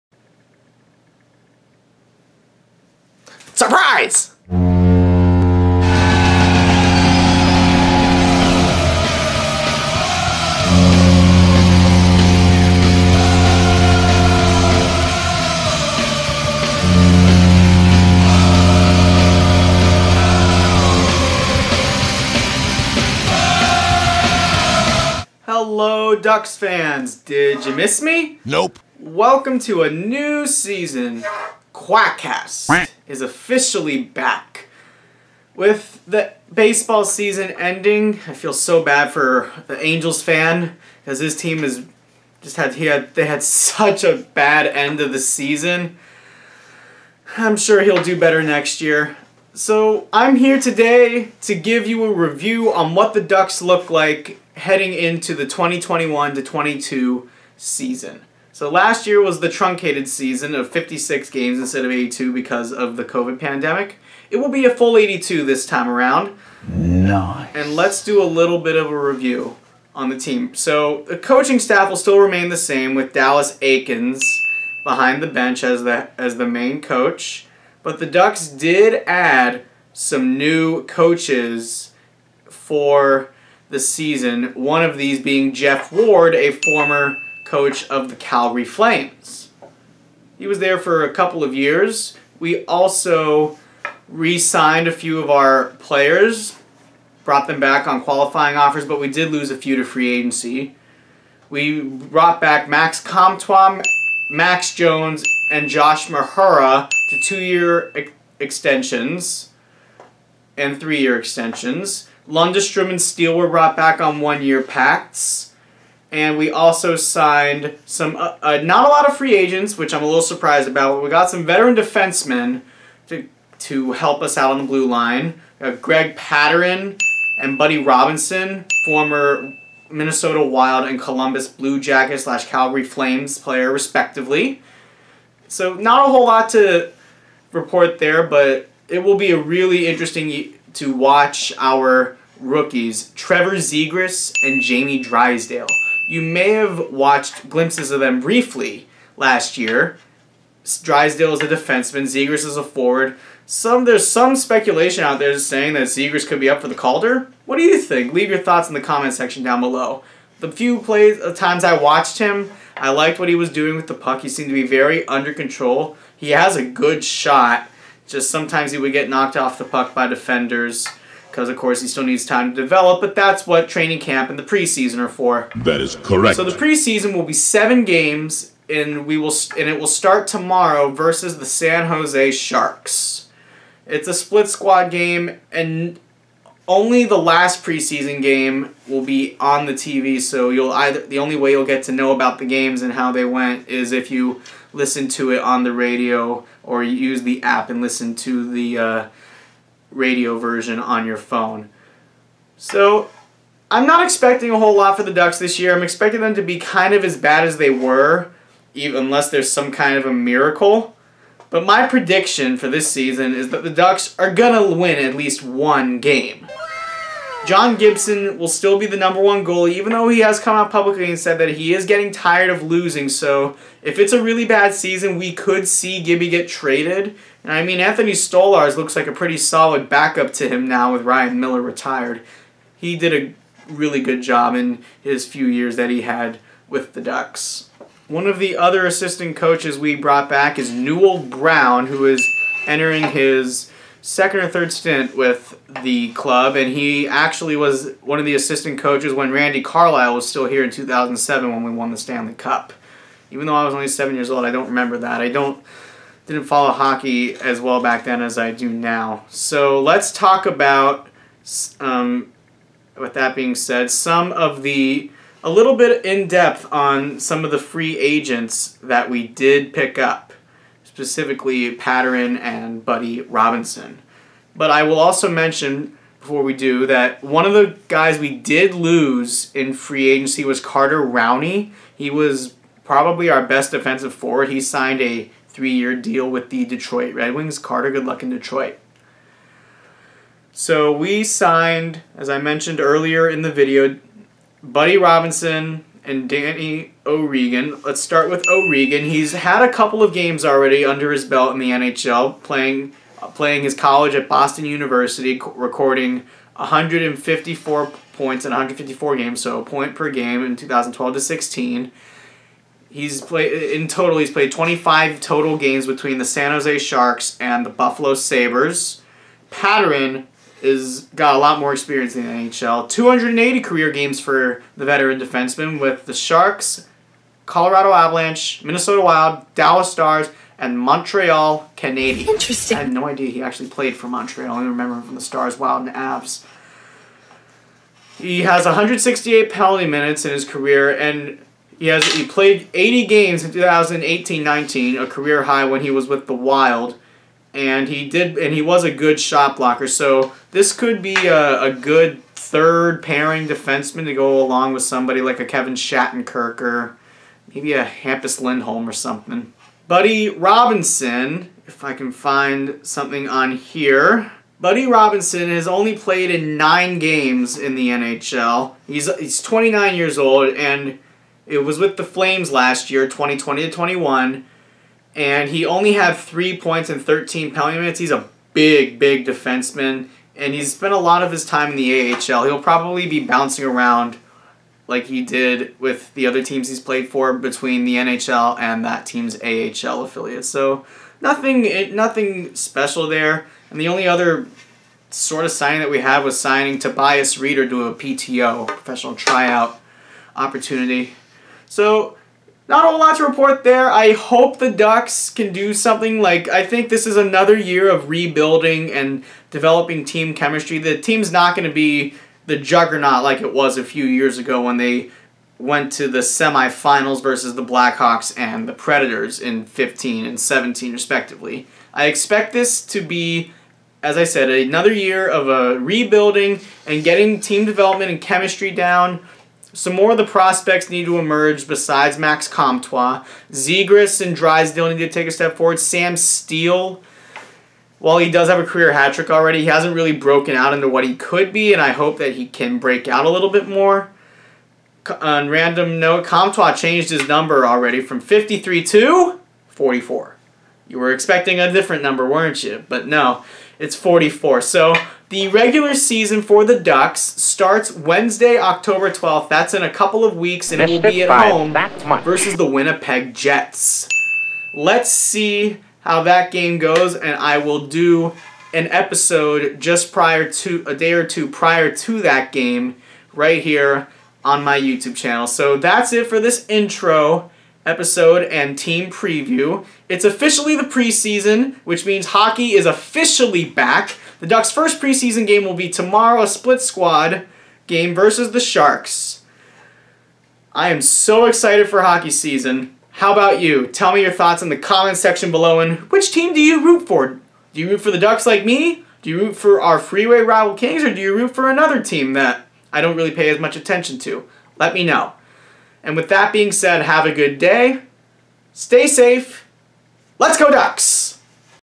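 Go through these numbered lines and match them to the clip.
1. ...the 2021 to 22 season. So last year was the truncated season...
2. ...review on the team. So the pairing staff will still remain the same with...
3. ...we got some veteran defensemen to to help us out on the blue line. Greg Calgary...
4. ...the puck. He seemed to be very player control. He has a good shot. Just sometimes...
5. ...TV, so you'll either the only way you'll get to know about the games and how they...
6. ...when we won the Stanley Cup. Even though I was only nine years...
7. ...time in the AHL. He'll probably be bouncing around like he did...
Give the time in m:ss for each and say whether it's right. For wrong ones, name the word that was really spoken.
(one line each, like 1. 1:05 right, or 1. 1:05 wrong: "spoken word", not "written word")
1. 0:55 right
2. 1:08 wrong: "coaching", not "pairing"
3. 2:01 wrong: "Pateryn", not "Calgary"
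4. 2:43 wrong: "under", not "player"
5. 3:09 right
6. 4:11 wrong: "seven", not "nine"
7. 6:21 right.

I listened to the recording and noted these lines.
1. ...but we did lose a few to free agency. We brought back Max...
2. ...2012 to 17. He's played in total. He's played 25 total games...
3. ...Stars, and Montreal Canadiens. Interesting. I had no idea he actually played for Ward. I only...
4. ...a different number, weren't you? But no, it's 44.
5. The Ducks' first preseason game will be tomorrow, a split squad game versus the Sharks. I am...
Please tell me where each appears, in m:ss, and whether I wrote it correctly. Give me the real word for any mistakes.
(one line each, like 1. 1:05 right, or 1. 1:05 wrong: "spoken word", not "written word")
1. 1:38 right
2. 5:10 wrong: "16", not "17"
3. 5:29 wrong: "Montreal", not "Ward"
4. 7:31 right
5. 8:04 right.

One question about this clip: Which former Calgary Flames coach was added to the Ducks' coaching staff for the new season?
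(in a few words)
Jeff Ward.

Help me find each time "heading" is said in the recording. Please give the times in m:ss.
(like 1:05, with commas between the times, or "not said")
0:54.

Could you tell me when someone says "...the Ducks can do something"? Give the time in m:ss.
6:44.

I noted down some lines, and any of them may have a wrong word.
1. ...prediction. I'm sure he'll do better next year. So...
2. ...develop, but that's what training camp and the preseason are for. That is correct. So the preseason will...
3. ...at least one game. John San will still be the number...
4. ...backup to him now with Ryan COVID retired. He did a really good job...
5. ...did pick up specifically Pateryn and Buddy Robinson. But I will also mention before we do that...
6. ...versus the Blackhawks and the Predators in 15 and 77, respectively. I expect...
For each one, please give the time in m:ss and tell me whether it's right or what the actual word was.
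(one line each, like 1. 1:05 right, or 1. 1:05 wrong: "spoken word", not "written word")
1. 0:45 wrong: "season", not "prediction"
2. 2:52 right
3. 3:35 wrong: "Gibson", not "San"
4. 3:49 wrong: "Miller", not "COVID"
5. 4:29 right
6. 6:57 wrong: "17", not "77".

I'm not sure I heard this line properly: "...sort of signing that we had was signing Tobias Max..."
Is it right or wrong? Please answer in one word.
wrong.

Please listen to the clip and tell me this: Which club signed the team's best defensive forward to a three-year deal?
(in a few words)
Detroit Red Wings.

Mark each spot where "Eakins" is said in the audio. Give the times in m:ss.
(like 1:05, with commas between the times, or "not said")
1:13.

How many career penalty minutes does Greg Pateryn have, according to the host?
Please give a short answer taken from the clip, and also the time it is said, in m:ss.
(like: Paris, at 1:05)
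168, at 5:38.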